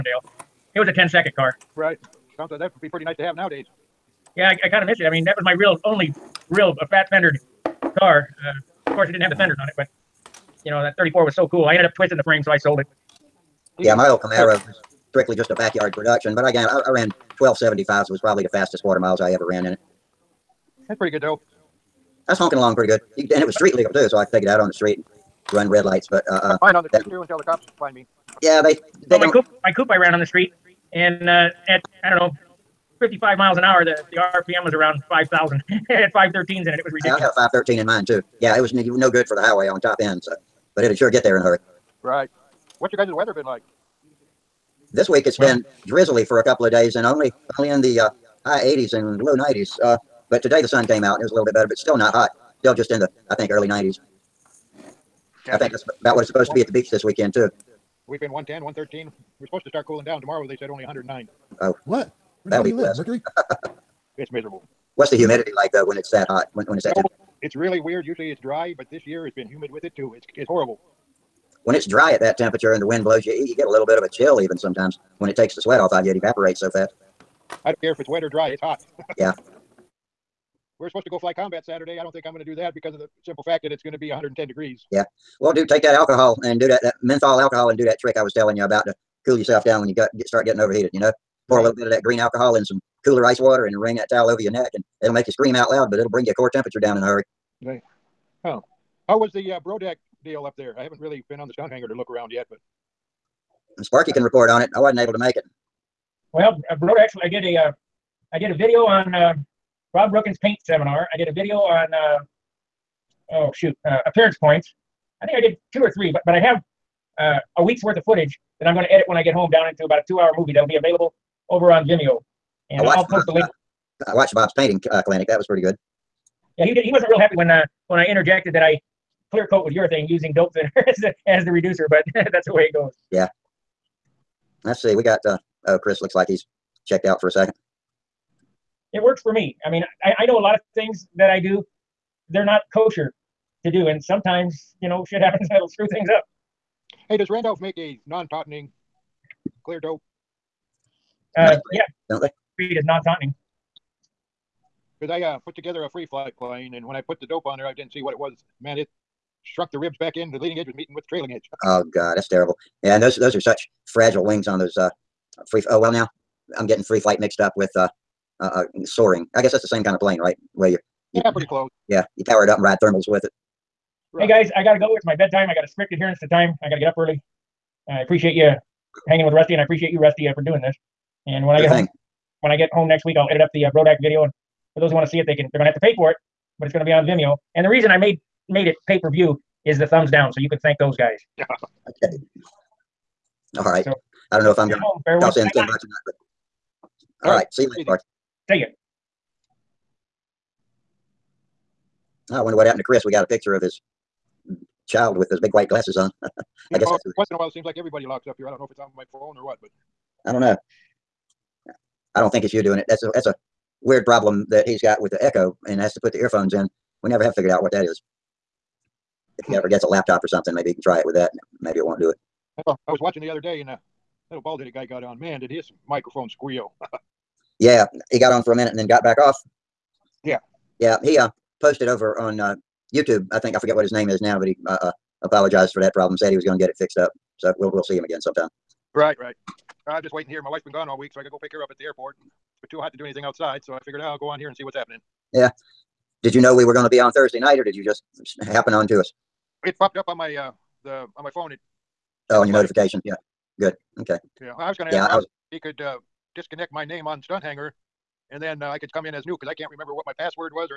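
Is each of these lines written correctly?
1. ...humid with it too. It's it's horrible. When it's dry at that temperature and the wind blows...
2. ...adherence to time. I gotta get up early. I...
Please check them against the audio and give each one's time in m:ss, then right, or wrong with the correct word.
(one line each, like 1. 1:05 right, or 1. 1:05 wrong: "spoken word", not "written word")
1. 1:09 right
2. 2:55 right.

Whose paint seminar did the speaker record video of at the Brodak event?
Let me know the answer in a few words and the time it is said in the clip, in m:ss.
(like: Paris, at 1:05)
Rob Brookins, at 1:49.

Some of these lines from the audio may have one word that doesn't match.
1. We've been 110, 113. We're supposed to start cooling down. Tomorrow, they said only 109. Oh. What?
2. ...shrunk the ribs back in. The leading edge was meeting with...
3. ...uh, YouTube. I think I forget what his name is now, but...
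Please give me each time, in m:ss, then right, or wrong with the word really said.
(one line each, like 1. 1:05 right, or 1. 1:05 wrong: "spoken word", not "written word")
1. 0:58 right
2. 2:39 right
3. 3:52 right.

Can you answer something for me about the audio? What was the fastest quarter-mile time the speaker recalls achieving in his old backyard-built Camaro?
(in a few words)
12.75.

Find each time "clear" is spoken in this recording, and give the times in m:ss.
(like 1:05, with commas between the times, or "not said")
2:09, 2:29.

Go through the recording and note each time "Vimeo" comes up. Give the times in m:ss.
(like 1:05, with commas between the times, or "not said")
2:01, 3:07.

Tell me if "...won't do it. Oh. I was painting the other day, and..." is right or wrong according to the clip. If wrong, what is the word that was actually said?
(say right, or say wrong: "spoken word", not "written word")
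wrong: "watching", not "painting".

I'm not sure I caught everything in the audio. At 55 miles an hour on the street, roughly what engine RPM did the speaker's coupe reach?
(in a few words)
5,000.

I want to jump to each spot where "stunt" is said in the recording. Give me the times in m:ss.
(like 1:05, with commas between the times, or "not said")
1:41, 4:17.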